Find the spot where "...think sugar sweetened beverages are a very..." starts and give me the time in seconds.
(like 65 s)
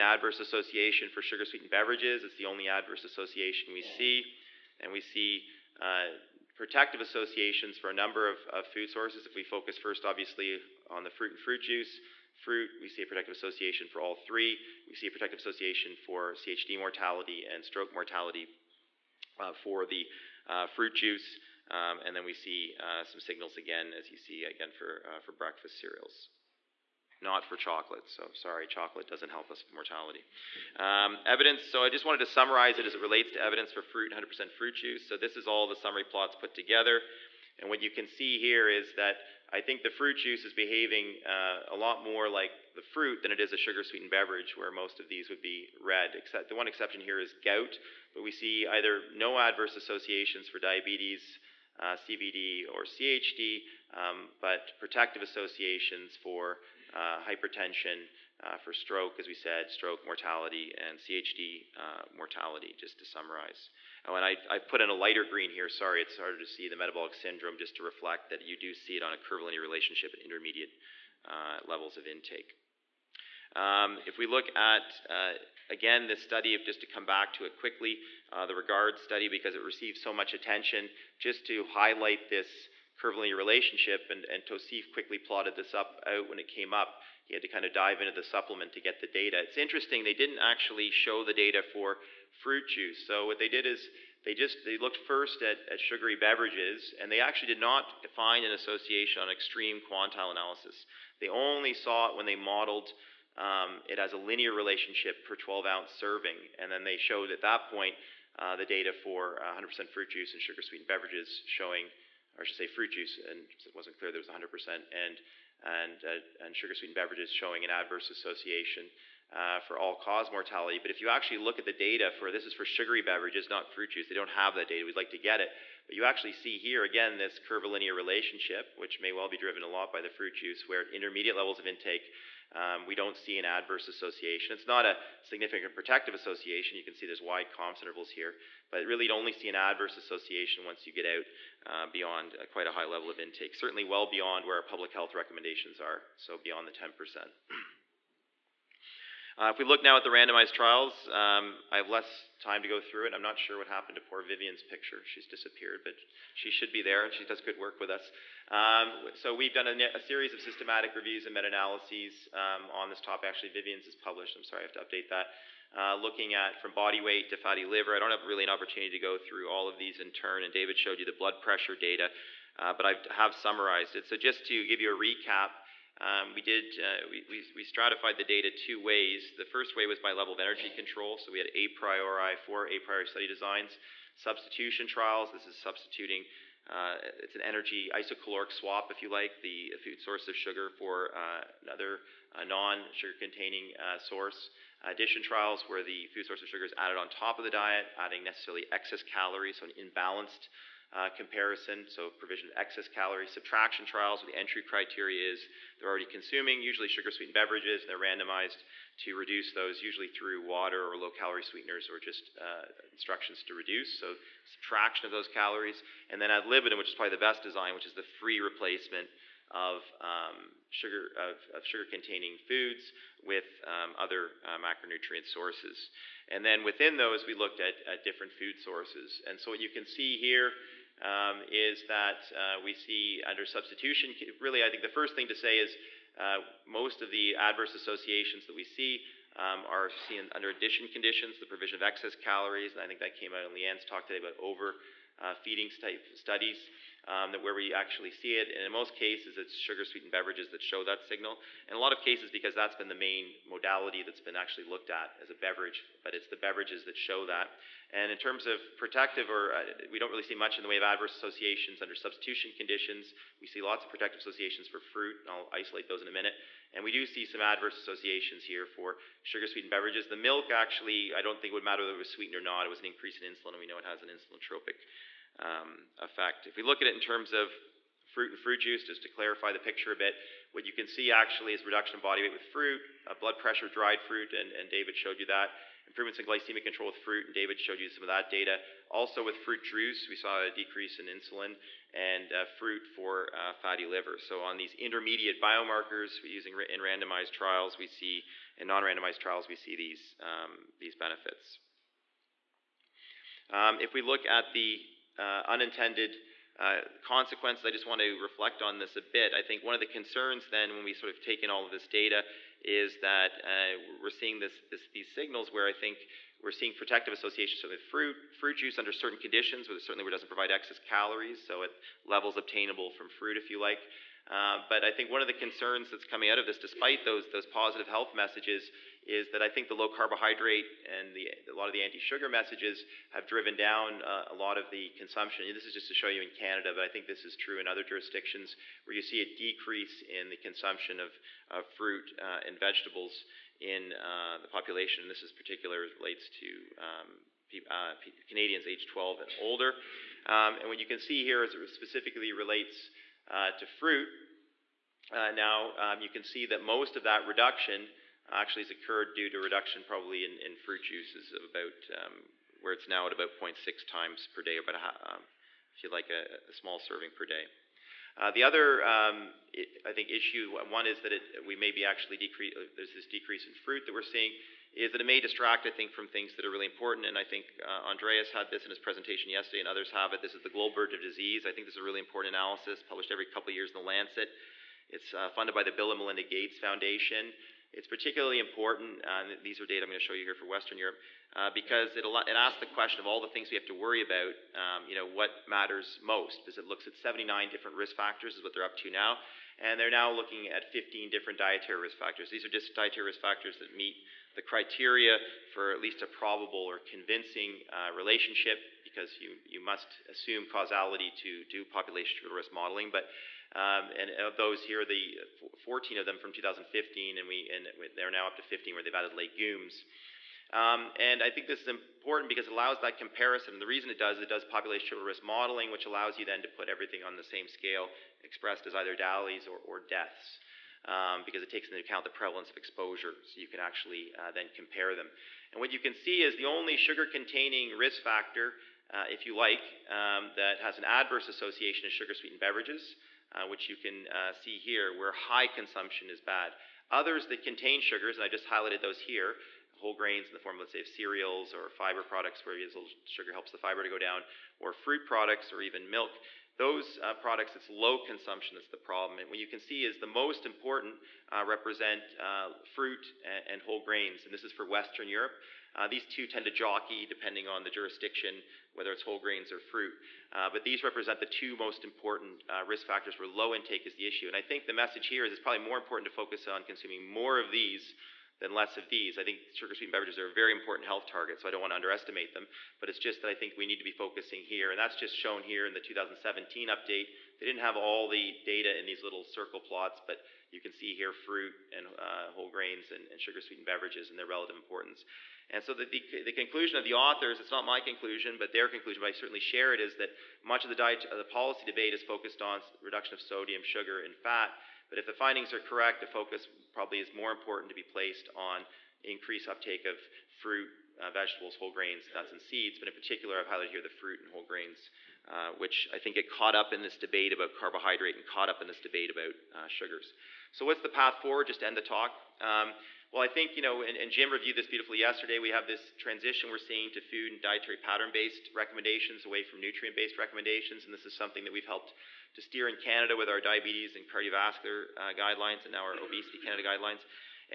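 479 s.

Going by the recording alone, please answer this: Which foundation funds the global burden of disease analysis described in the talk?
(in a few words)
Bill and Melinda Gates Foundation.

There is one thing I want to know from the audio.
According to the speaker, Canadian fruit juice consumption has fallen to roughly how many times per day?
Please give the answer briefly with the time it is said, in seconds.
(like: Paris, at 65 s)
0.6, at 363 s.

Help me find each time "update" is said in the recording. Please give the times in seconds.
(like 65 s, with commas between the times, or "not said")
164 s, 486 s.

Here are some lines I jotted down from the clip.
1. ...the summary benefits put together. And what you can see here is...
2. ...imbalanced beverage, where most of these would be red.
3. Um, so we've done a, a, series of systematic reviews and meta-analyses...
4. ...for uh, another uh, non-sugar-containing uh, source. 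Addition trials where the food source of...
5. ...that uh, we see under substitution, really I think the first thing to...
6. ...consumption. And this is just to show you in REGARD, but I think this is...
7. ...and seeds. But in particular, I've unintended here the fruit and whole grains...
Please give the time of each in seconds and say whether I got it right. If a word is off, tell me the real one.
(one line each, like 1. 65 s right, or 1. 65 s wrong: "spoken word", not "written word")
1. 35 s wrong: "plots", not "benefits"
2. 43 s wrong: "sweetened", not "imbalanced"
3. 158 s right
4. 190 s right
5. 231 s right
6. 334 s wrong: "Canada", not "REGARD"
7. 512 s wrong: "highlighted", not "unintended".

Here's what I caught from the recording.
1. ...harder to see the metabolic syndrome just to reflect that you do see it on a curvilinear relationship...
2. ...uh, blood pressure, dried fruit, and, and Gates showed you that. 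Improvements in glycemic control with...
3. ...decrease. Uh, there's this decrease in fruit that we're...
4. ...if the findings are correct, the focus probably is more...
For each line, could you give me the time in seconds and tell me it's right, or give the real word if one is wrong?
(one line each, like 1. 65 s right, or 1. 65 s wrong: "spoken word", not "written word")
1. 66 s right
2. 283 s wrong: "David", not "Gates"
3. 372 s right
4. 504 s right.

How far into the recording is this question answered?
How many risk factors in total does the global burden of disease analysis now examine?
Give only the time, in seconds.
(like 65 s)
396 s.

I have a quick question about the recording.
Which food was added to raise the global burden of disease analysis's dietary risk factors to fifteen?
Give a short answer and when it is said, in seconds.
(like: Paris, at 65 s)
Legumes, at 419 s.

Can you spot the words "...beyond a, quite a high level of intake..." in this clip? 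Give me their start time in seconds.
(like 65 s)
141 s.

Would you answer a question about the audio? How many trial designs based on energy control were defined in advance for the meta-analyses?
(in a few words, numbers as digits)
4.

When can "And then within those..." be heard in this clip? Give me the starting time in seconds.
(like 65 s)
226 s.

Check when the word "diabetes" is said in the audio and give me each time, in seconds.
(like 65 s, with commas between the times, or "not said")
50 s, 533 s.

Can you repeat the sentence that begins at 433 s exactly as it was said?
So you can actually uh, then compare them.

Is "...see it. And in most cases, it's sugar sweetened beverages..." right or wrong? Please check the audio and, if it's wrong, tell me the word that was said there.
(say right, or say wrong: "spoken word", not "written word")
right.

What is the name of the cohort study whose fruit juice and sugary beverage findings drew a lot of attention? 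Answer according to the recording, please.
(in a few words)
REGARD.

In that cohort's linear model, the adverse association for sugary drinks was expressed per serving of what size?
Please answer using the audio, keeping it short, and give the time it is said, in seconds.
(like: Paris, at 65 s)
12 ounces, at 105 s.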